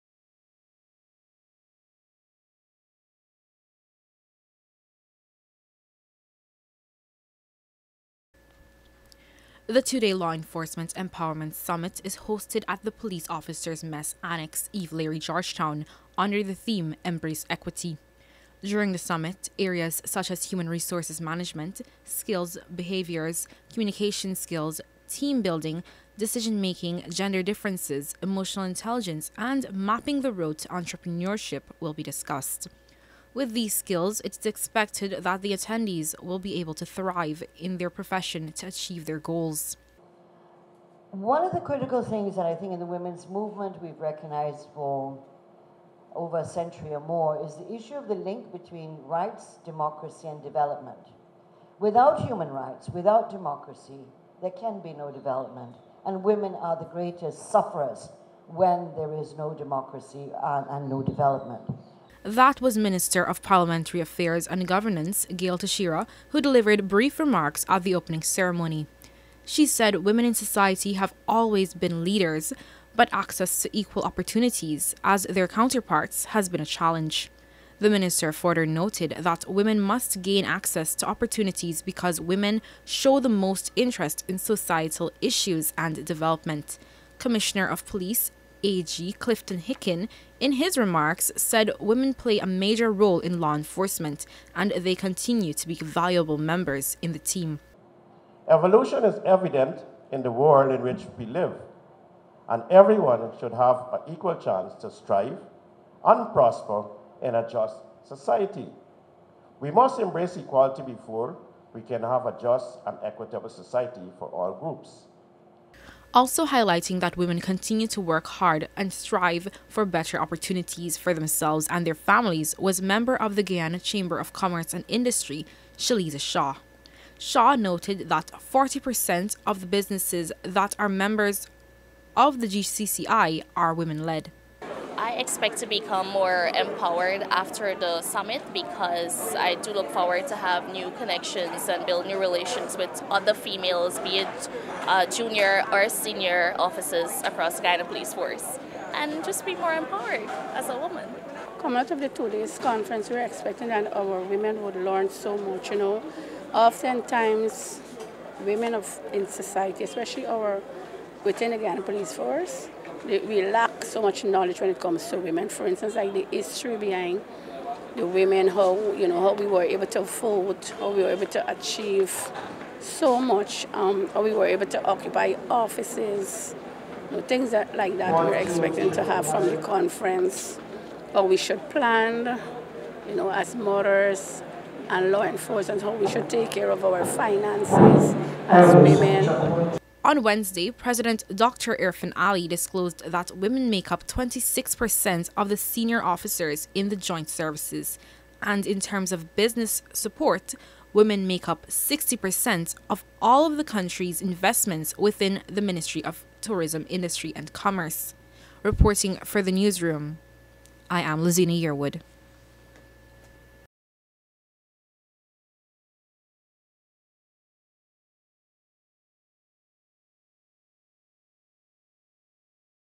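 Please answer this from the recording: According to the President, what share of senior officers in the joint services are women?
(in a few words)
26%.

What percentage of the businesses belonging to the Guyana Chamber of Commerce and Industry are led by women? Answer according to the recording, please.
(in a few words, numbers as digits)
40%.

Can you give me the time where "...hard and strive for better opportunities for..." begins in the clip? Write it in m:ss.
1:58.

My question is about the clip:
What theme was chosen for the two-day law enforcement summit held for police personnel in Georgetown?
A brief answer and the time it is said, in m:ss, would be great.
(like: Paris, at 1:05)
Embrace Equity, at 0:17.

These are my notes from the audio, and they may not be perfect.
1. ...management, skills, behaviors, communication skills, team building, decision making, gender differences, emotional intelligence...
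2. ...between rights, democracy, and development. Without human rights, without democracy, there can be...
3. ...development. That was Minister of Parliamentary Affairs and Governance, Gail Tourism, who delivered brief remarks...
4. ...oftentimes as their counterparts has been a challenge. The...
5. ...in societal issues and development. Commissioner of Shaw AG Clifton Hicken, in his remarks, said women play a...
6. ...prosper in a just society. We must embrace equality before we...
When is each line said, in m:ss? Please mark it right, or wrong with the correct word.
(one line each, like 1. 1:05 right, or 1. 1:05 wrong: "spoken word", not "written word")
1. 0:21 right
2. 0:48 right
3. 1:01 wrong: "Teixeira", not "Tourism"
4. 1:14 wrong: "opportunities", not "oftentimes"
5. 1:24 wrong: "Police", not "Shaw"
6. 1:46 right.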